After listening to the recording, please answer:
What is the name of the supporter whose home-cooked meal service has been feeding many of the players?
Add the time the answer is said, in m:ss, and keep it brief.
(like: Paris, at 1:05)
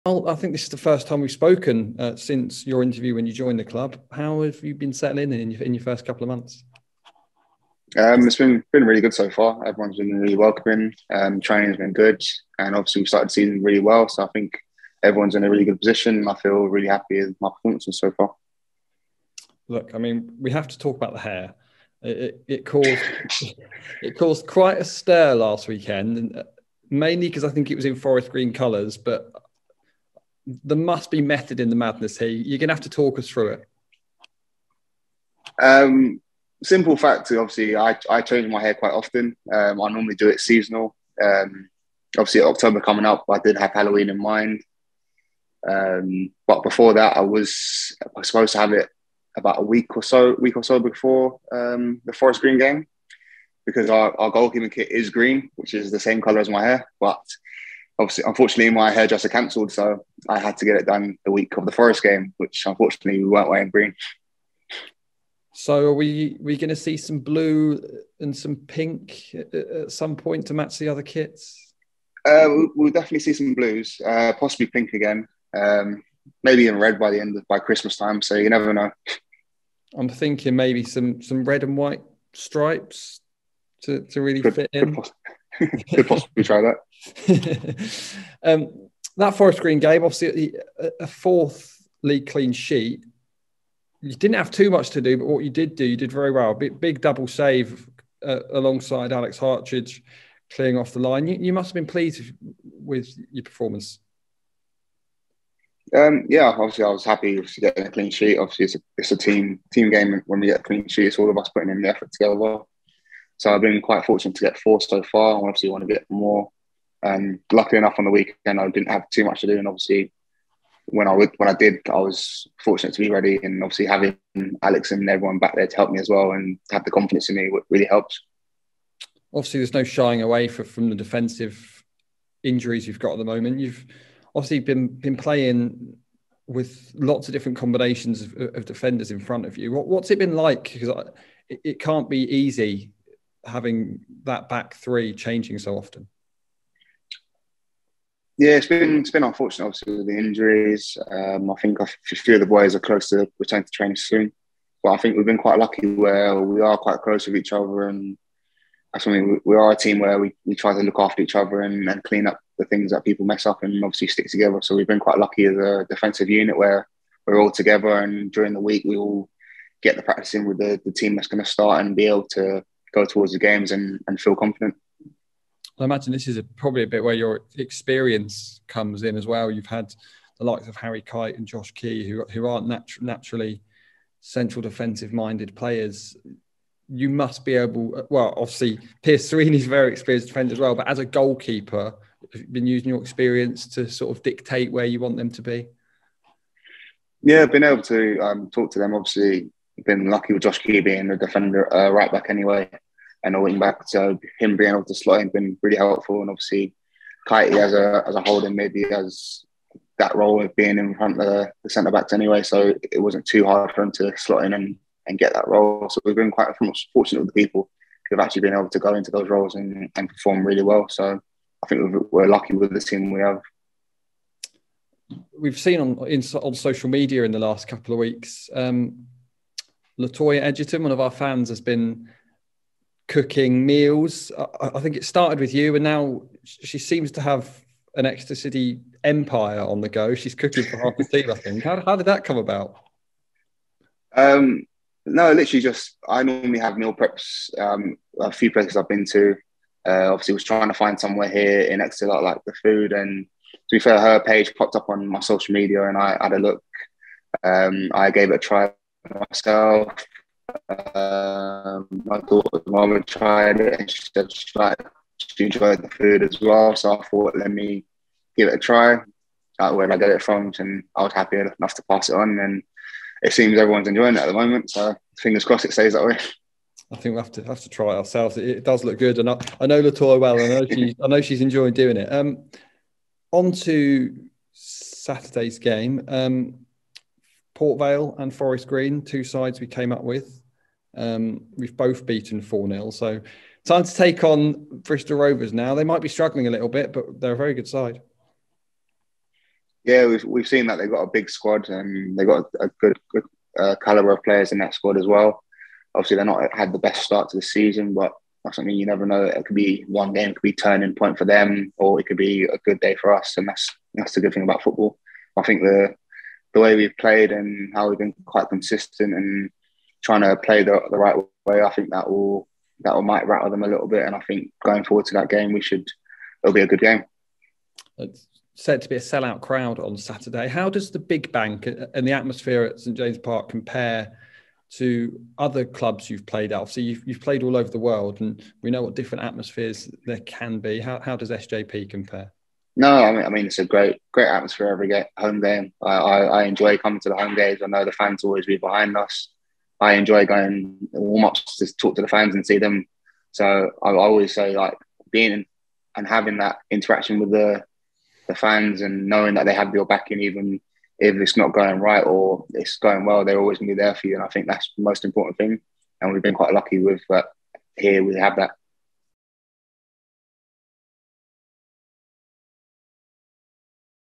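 Latoya Edgerton, at 3:49.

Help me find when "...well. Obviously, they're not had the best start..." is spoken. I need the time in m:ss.
5:05.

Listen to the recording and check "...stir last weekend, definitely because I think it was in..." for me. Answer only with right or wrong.
wrong.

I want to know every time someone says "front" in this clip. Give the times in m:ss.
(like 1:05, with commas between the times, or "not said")
2:19, 3:30.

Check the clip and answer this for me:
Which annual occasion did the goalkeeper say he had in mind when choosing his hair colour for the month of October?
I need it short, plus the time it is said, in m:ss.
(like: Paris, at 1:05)
Halloween, at 0:43.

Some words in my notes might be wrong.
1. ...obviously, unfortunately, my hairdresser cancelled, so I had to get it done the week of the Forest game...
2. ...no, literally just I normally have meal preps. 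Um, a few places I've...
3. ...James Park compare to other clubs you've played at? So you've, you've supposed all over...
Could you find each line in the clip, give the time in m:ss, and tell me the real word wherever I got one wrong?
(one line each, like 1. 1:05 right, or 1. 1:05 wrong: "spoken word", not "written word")
1. 0:58 right
2. 4:05 right
3. 5:32 wrong: "played", not "supposed".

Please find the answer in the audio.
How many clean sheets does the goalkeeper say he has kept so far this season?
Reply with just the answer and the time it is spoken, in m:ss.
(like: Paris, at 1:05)
4, at 1:54.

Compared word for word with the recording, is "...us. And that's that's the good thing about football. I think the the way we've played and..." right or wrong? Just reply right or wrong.
right.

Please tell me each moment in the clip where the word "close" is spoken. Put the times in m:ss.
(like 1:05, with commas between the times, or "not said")
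2:32, 2:37.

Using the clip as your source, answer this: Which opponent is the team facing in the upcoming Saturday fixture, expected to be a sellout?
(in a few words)
Bristol Rovers.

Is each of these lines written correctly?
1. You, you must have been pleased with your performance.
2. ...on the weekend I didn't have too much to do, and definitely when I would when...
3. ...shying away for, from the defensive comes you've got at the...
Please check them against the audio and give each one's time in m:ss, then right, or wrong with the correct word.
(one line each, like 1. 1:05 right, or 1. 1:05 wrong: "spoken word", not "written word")
1. 1:41 right
2. 1:57 wrong: "obviously", not "definitely"
3. 2:09 wrong: "injuries", not "comes".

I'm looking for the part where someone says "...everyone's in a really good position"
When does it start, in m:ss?
0:15.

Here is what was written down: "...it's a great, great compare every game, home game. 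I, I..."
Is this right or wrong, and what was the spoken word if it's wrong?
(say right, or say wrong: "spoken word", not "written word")
wrong: "atmosphere", not "compare".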